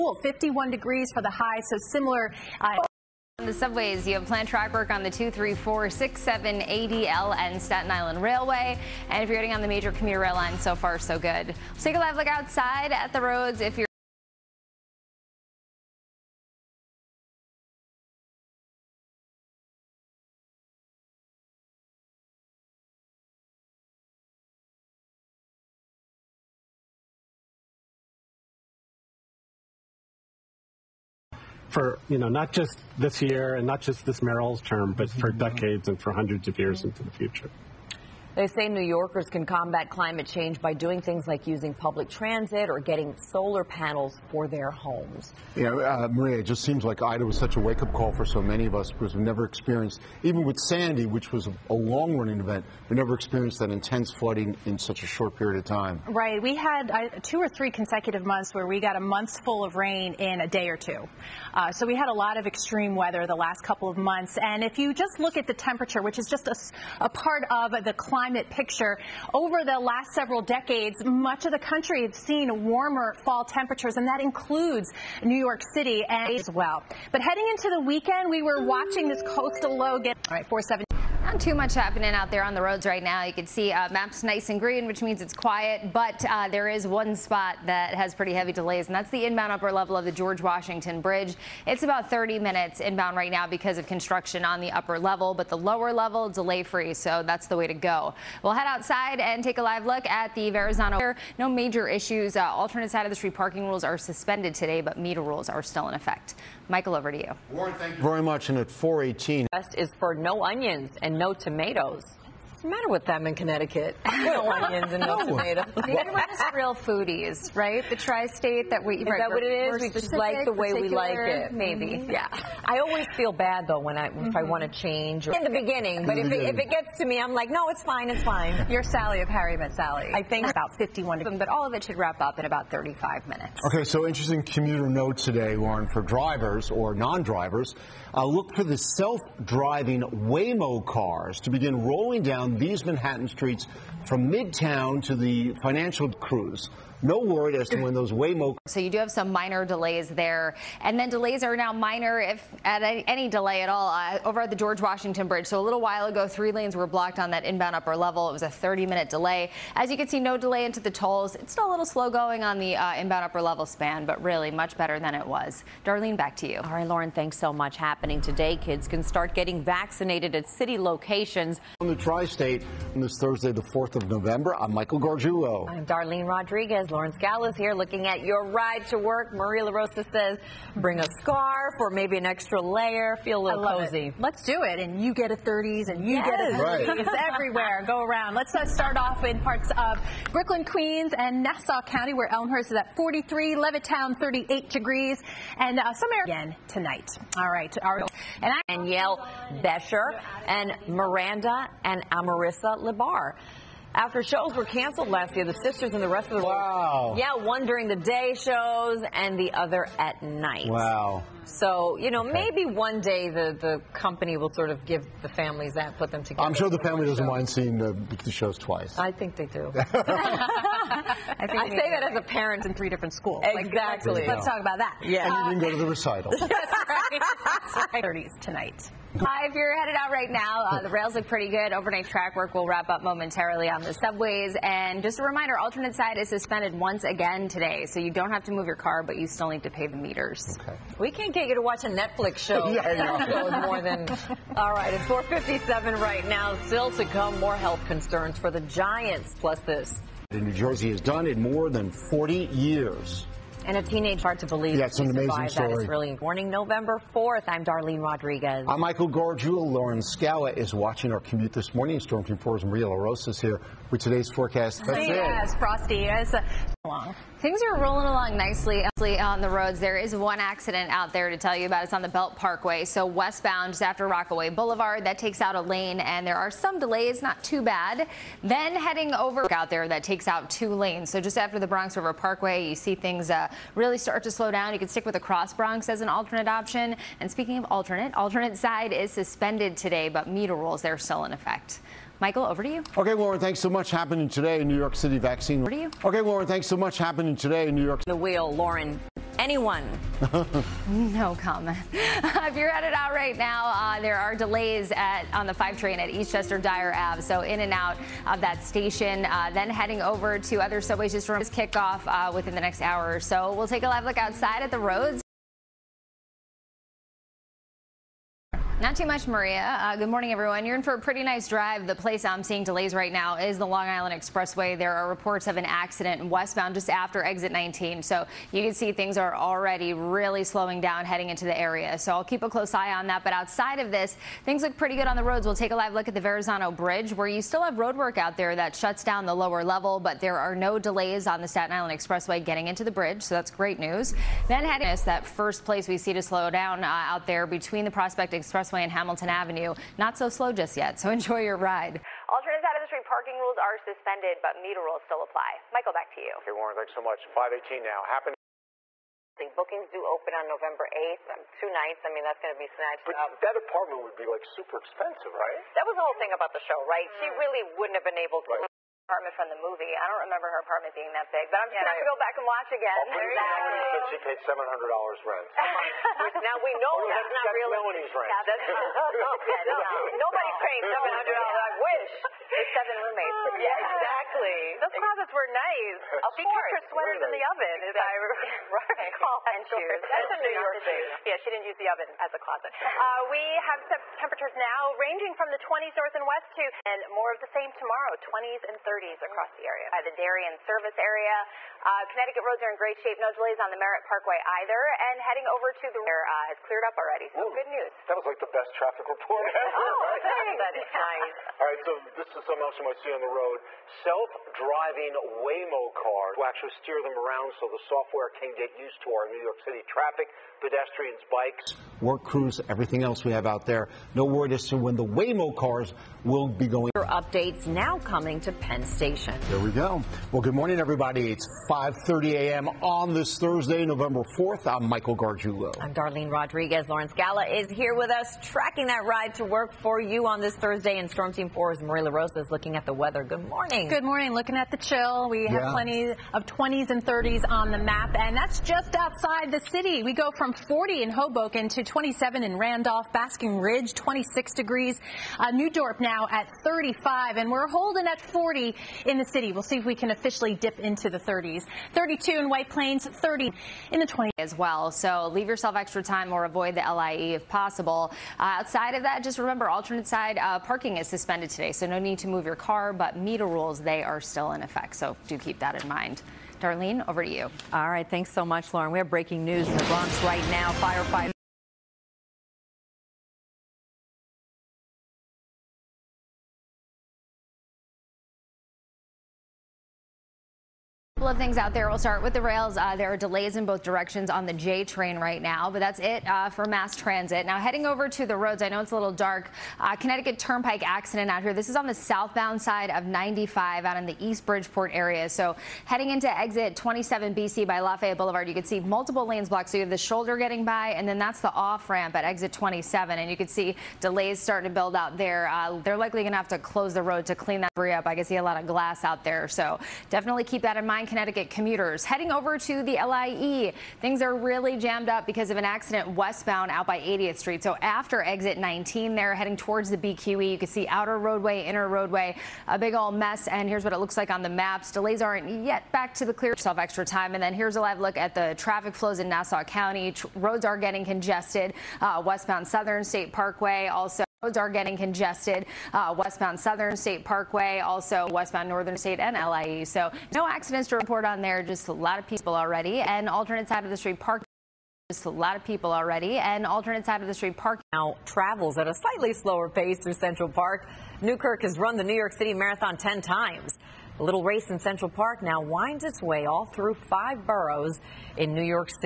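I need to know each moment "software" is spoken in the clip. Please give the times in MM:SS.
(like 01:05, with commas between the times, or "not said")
06:57.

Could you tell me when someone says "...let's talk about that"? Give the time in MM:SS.
03:44.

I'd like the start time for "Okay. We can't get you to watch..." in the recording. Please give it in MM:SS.
04:00.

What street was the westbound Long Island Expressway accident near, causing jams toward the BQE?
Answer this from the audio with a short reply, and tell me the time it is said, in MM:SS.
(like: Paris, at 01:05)
80th Street, at 08:47.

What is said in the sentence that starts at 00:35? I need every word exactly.
decades and for hundreds of years into the future.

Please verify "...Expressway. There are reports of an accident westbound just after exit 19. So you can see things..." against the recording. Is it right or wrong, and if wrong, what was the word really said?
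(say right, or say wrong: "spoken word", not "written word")
right.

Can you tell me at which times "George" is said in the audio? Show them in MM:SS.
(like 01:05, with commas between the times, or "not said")
01:30, 02:34.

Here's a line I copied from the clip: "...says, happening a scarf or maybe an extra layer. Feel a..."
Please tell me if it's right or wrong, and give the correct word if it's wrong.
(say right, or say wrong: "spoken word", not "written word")
wrong: "bring", not "happening".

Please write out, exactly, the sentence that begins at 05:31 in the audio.
So I'll keep a close eye on that.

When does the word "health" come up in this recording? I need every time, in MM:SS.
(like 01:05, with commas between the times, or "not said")
04:07.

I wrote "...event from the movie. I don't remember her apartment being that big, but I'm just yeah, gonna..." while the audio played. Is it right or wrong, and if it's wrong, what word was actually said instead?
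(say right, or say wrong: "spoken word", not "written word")
wrong: "apartment", not "event".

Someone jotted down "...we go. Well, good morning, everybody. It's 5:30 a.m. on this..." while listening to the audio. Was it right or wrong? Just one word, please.
right.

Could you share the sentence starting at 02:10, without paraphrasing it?
I think about 51 of them, but all of it should wrap up in about 35 minutes.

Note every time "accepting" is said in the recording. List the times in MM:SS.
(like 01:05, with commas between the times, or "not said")
not said.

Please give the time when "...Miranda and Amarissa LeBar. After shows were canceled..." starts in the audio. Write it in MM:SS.
03:20.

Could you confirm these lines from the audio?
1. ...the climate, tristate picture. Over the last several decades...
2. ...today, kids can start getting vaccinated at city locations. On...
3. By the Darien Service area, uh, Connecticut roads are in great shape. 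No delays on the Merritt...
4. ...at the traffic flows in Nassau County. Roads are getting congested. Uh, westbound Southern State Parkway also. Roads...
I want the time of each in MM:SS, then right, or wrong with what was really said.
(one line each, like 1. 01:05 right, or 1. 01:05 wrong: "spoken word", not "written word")
1. 01:07 wrong: "climate", not "tristate"
2. 02:48 right
3. 06:39 right
4. 08:58 right.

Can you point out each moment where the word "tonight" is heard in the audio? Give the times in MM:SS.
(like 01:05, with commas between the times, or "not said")
03:16, 03:48.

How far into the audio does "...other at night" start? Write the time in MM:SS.
03:29.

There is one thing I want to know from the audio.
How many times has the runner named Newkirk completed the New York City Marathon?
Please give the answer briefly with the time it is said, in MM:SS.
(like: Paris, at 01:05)
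10, at 09:22.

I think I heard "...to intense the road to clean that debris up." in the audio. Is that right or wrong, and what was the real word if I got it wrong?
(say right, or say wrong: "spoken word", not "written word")
wrong: "close", not "intense".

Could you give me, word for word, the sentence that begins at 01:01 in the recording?
Uh, so we had a lot of extreme weather the last couple of months.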